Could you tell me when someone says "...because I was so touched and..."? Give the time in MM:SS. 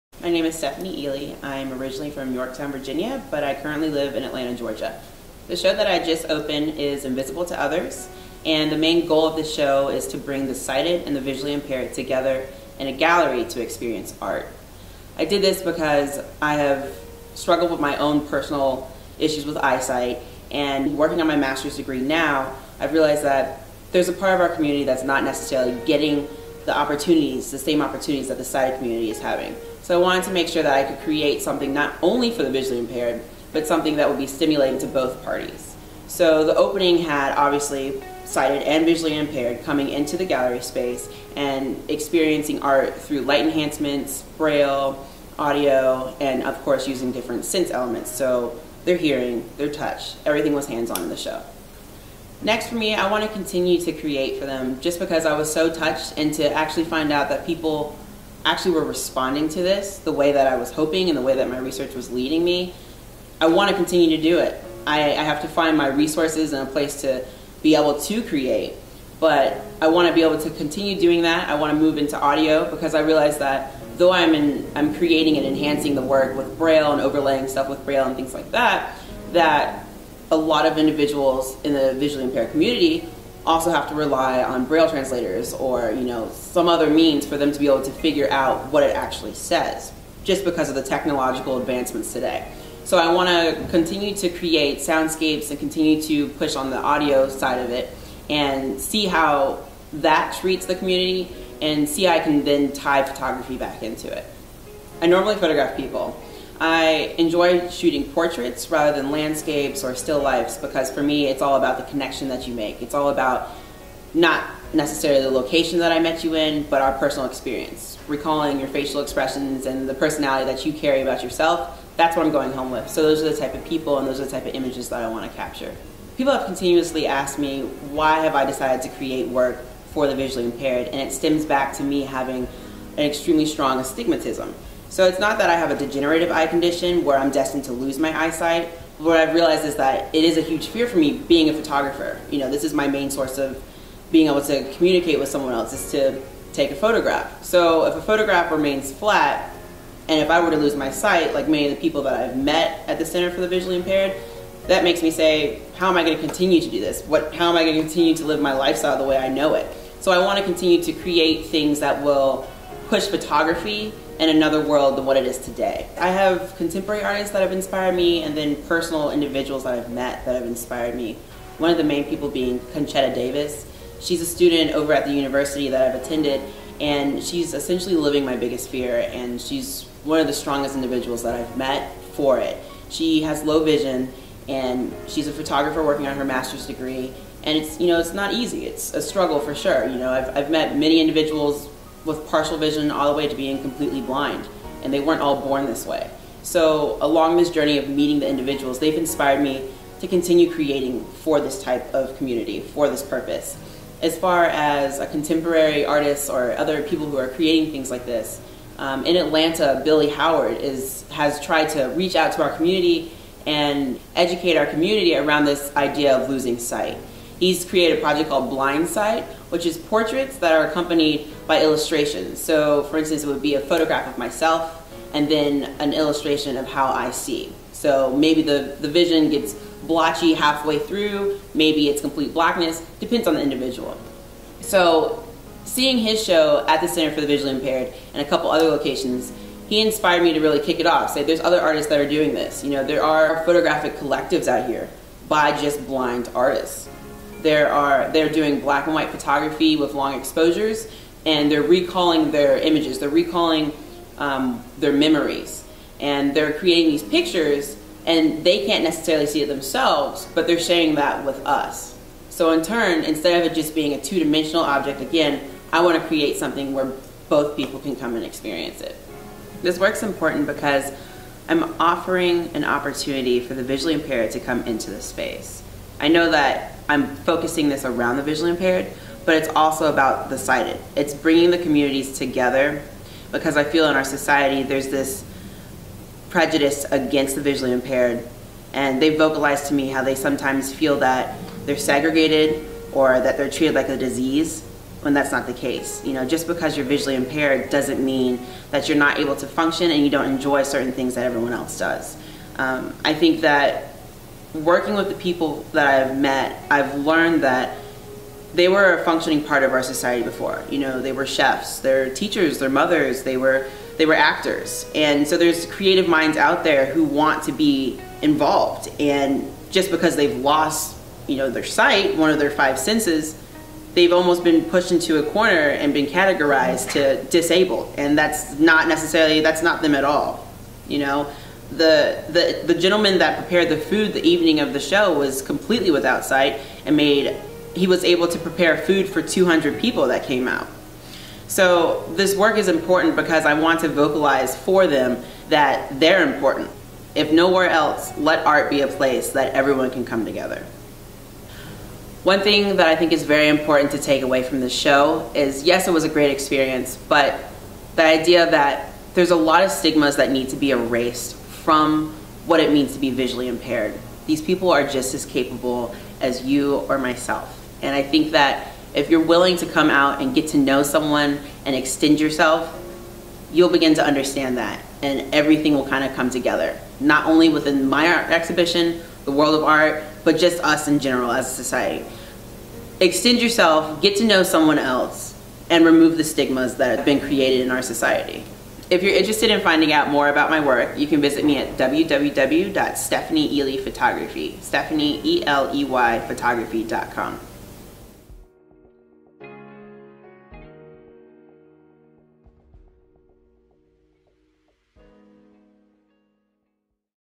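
00:54.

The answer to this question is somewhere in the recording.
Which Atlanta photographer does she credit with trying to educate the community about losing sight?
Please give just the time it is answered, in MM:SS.
03:29.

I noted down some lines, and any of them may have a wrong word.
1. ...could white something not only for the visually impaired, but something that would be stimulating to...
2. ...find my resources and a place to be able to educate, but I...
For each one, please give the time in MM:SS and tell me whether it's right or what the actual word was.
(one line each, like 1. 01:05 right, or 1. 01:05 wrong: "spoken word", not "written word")
1. 00:30 wrong: "create", not "white"
2. 01:05 wrong: "create", not "educate".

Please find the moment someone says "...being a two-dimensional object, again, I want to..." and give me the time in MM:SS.
04:23.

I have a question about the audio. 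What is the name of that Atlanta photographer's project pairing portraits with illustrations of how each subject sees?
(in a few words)
Blind Sight.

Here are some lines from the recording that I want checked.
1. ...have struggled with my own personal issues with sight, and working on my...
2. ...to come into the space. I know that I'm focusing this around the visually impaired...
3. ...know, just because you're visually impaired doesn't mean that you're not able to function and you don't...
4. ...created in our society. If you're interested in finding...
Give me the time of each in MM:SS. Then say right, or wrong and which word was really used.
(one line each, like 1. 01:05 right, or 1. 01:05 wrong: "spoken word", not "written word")
1. 00:16 wrong: "eyesight", not "sight"
2. 04:34 right
3. 04:56 right
4. 06:27 right.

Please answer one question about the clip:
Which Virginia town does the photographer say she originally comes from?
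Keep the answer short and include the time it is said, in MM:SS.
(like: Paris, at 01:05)
Yorktown, at 00:02.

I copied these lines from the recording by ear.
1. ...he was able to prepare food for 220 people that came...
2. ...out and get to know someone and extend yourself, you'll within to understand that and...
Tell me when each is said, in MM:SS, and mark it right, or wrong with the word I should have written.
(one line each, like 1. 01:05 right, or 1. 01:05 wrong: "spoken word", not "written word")
1. 05:37 wrong: "200", not "220"
2. 06:09 wrong: "begin", not "within".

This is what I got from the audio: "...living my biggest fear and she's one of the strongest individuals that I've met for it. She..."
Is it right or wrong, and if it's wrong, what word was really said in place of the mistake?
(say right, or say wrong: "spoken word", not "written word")
right.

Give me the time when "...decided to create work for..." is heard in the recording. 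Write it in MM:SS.
02:08.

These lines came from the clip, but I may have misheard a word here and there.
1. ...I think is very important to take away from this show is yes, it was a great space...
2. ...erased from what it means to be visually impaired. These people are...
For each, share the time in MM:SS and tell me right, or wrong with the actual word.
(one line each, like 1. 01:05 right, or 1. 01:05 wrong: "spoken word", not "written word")
1. 05:52 wrong: "experience", not "space"
2. 06:00 right.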